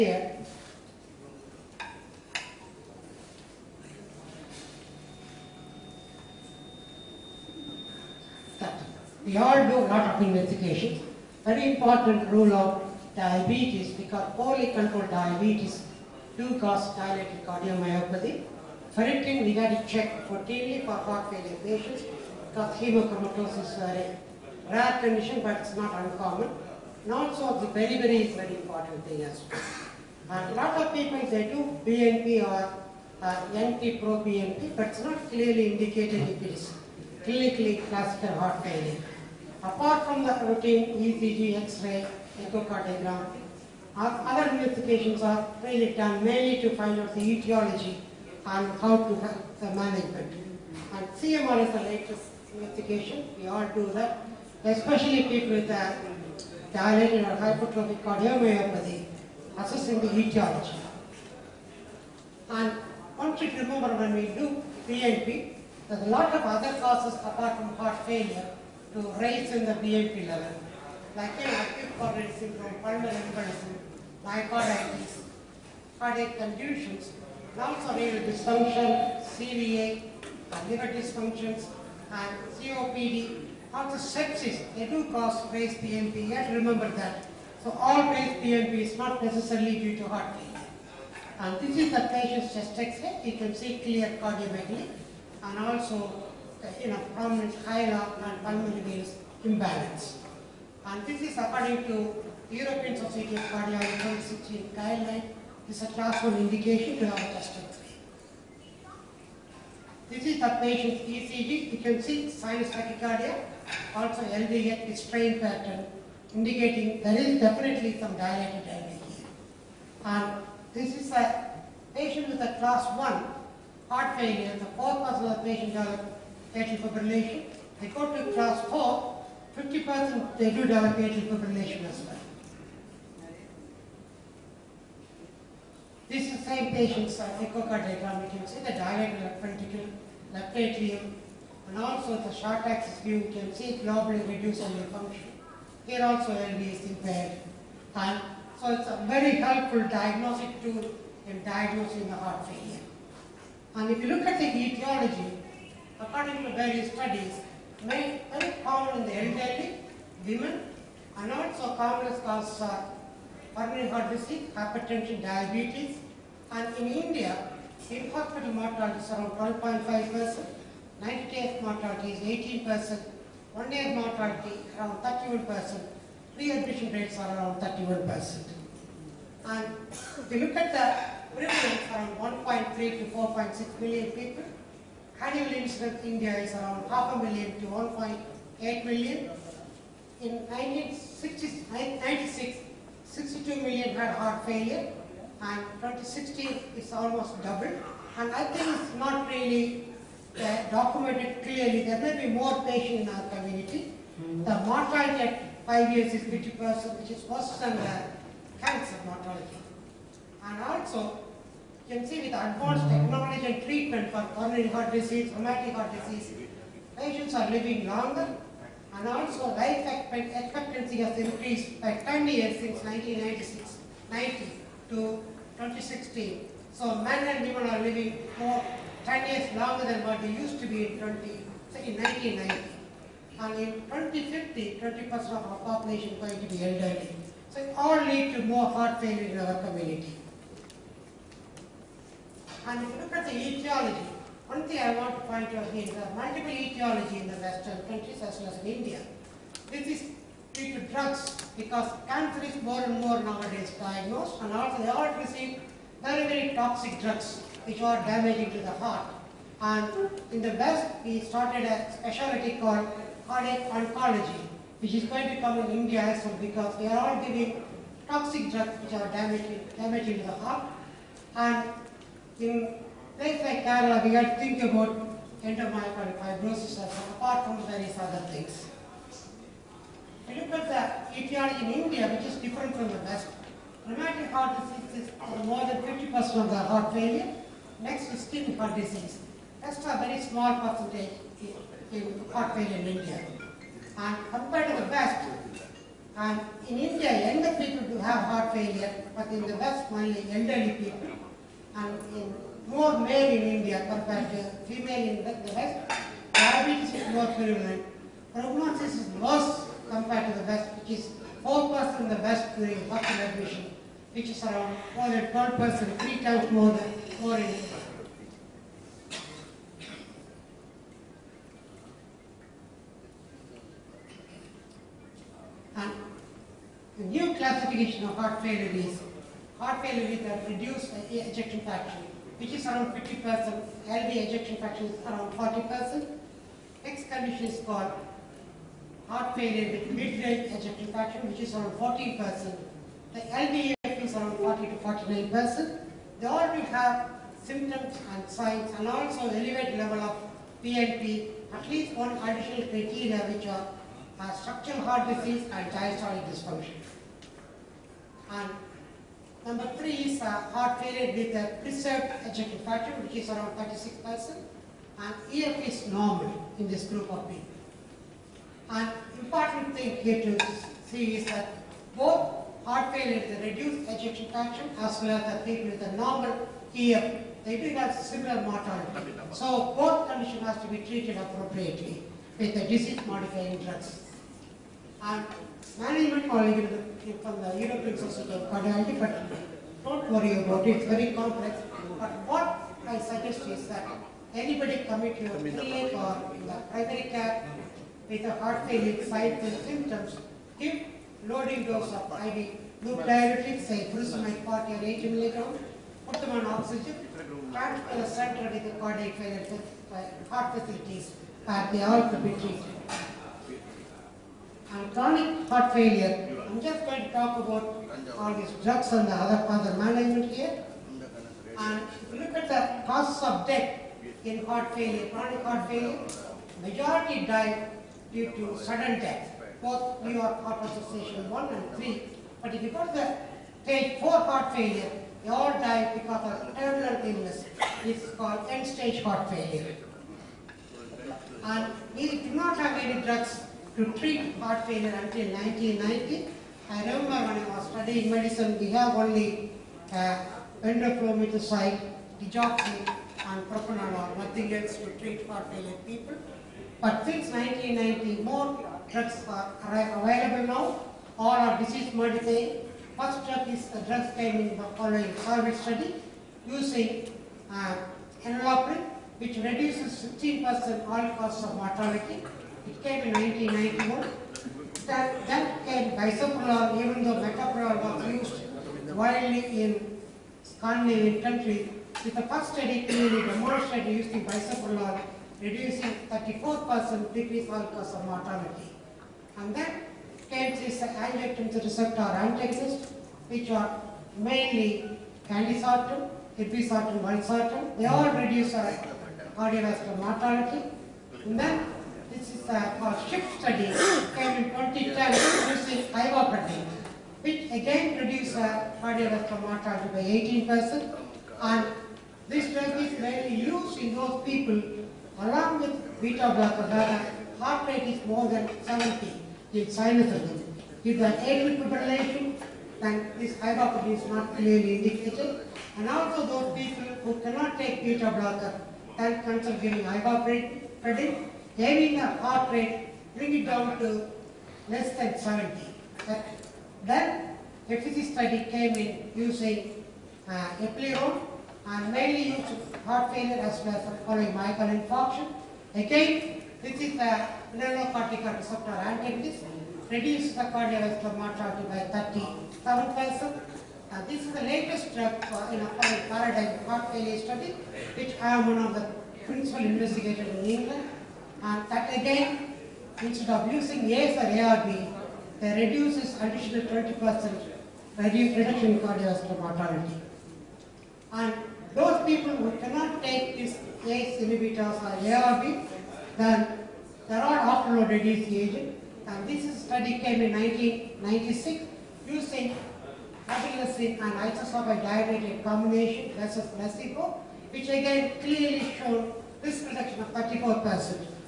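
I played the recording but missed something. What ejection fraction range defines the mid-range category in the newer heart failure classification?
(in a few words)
40 to 49%.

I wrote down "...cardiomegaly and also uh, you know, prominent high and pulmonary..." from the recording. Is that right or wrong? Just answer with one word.
right.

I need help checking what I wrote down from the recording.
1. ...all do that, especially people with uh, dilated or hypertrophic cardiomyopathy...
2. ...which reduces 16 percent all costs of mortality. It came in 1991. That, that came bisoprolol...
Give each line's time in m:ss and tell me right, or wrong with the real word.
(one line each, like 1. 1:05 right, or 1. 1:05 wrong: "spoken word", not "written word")
1. 0:53 right
2. 7:49 right.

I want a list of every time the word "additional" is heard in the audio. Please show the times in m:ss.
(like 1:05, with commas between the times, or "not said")
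5:52, 9:26.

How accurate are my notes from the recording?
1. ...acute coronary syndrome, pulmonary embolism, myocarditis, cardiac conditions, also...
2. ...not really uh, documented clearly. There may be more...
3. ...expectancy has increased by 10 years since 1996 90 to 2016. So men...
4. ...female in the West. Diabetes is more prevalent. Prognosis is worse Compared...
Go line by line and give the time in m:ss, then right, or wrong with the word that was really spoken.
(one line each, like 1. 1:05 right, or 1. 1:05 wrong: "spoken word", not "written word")
1. 1:11 right
2. 3:18 right
3. 3:40 right
4. 5:04 right.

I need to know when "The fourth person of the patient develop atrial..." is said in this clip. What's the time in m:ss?
2:04.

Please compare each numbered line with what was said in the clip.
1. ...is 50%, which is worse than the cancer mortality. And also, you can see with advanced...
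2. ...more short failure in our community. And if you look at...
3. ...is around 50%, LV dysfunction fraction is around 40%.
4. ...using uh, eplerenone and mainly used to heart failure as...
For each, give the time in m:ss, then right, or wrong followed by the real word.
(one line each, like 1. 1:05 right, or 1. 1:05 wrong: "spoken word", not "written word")
1. 3:26 right
2. 3:58 wrong: "heart", not "short"
3. 5:32 wrong: "ejection", not "dysfunction"
4. 8:59 right.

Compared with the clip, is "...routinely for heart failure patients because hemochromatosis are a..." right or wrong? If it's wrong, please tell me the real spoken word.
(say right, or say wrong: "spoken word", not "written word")
right.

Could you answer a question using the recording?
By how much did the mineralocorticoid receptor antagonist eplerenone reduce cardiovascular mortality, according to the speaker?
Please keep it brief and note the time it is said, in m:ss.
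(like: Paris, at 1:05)
37%, at 9:12.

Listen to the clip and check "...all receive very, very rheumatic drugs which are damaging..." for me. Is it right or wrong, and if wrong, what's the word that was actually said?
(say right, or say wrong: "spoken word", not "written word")
wrong: "toxic", not "rheumatic".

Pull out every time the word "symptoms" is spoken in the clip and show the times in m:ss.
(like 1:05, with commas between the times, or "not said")
5:47, 6:39.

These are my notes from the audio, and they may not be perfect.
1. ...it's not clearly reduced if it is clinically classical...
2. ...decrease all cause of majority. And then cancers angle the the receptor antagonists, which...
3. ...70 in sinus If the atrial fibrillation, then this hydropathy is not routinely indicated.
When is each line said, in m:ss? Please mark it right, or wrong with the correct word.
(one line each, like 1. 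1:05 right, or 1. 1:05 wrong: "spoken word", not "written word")
1. 0:34 wrong: "indicated", not "reduced"
2. 8:07 wrong: "mortality", not "majority"
3. 8:38 wrong: "clearly", not "routinely".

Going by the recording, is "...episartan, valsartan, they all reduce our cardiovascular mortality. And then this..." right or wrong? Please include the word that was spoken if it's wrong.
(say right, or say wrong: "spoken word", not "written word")
right.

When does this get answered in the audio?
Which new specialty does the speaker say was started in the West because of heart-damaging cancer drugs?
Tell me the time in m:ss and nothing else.
4:23.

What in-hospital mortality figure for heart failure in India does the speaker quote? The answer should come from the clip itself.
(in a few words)
12.5%.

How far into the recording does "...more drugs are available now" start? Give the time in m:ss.
7:38.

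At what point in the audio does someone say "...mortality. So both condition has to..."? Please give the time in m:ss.
6:18.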